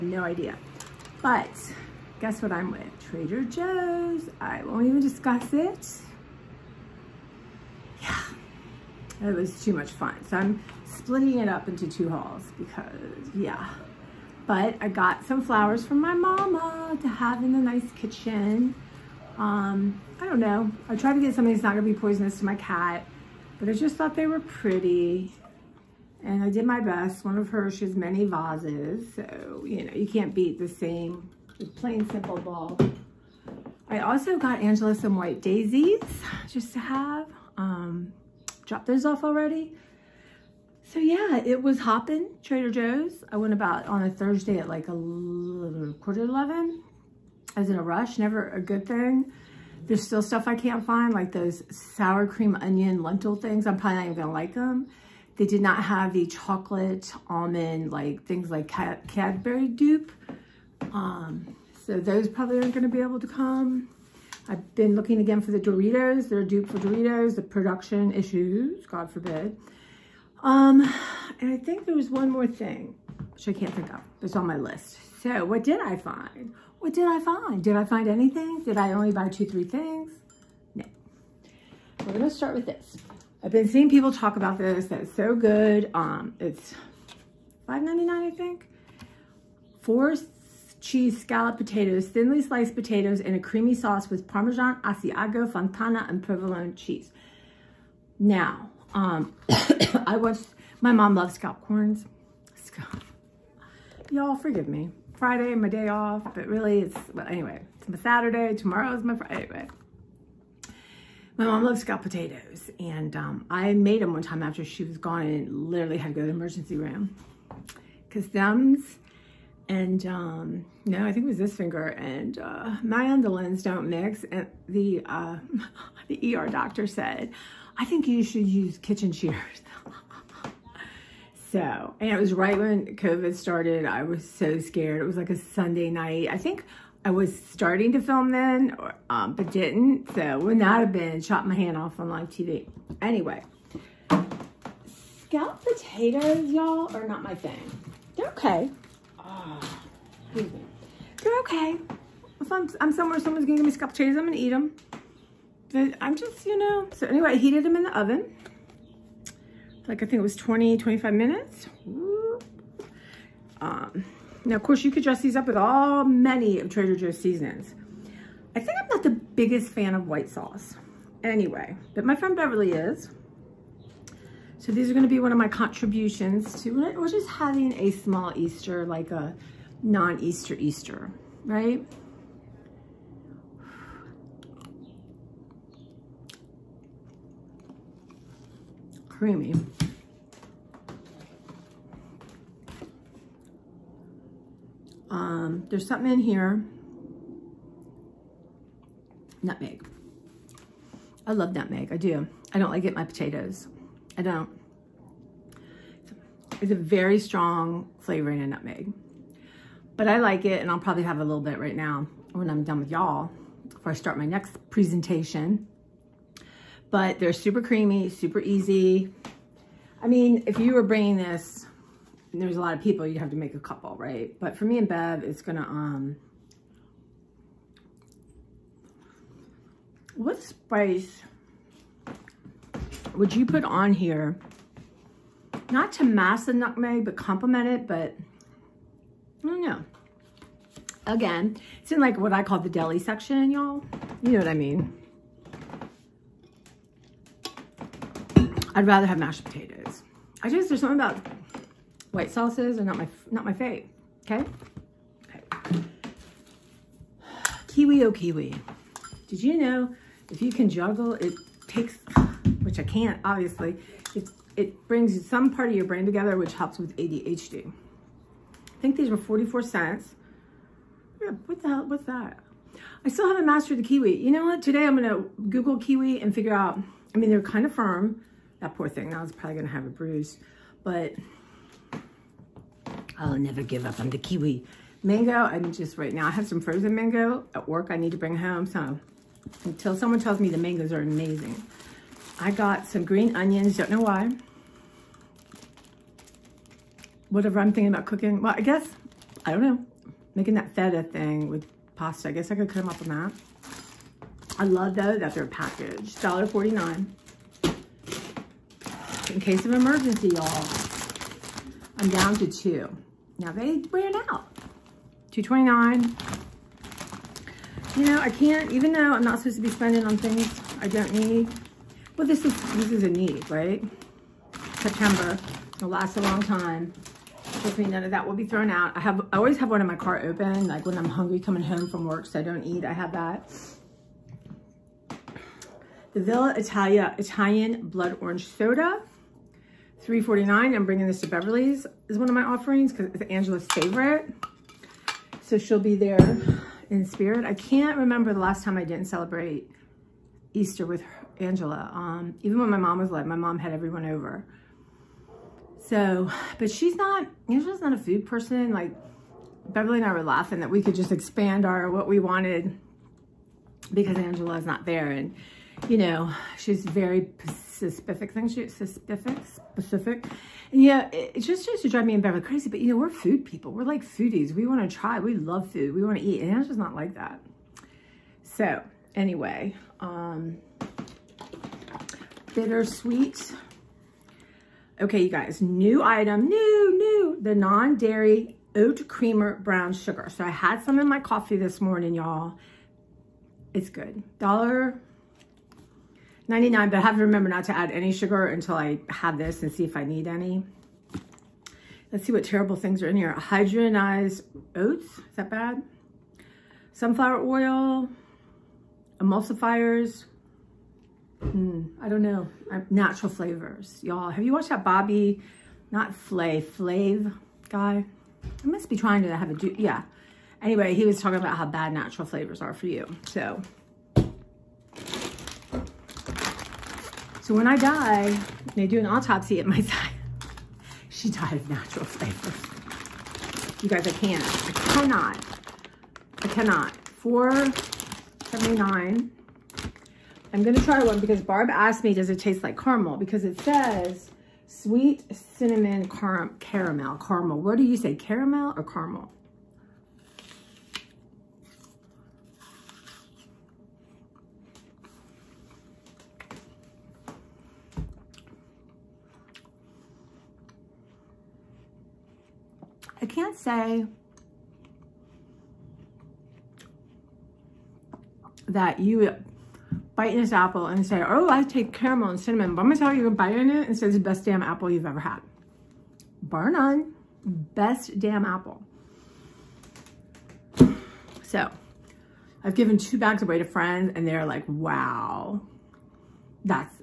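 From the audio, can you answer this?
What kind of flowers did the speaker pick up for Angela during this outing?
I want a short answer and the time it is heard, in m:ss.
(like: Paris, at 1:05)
White daisies, at 0:35.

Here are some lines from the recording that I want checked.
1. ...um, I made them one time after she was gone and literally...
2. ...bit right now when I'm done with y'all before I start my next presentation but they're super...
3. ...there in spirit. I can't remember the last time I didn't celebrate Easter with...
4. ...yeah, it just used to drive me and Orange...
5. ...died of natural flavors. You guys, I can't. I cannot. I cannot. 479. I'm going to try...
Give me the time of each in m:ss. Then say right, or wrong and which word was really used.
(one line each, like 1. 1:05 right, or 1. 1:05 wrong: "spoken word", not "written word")
1. 1:53 right
2. 3:31 right
3. 5:45 right
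4. 6:10 wrong: "Beverly", not "Orange"
5. 7:11 right.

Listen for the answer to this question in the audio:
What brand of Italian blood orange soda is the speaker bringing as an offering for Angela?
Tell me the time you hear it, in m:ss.
5:36.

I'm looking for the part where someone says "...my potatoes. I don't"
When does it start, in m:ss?
3:22.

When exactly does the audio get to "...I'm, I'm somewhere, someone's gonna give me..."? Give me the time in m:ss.
2:32.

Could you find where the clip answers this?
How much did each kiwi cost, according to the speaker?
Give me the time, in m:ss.
4:29.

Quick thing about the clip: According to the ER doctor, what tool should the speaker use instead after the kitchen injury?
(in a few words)
Kitchen shears.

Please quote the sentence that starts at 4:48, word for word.
So until someone tells me the mangoes are amazing.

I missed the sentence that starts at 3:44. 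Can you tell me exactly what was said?
But for me and Bev, it's gonna, um, what spice would you put on here?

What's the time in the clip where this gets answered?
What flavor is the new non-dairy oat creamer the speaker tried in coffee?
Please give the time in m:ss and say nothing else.
6:29.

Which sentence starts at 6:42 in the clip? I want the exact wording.
Let's see what terrible things are in here.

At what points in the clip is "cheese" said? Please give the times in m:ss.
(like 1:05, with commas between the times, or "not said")
1:30, 1:36.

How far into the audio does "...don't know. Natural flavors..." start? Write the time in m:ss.
6:52.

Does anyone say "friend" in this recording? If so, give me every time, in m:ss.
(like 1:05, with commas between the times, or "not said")
2:52, 8:03.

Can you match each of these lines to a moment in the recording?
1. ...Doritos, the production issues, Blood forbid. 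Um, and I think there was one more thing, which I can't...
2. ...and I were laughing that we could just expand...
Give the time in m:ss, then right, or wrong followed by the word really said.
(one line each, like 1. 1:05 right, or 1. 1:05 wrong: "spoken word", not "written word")
1. 1:06 wrong: "God", not "Blood"
2. 5:59 right.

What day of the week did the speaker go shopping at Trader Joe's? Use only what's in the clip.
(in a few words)
Thursday.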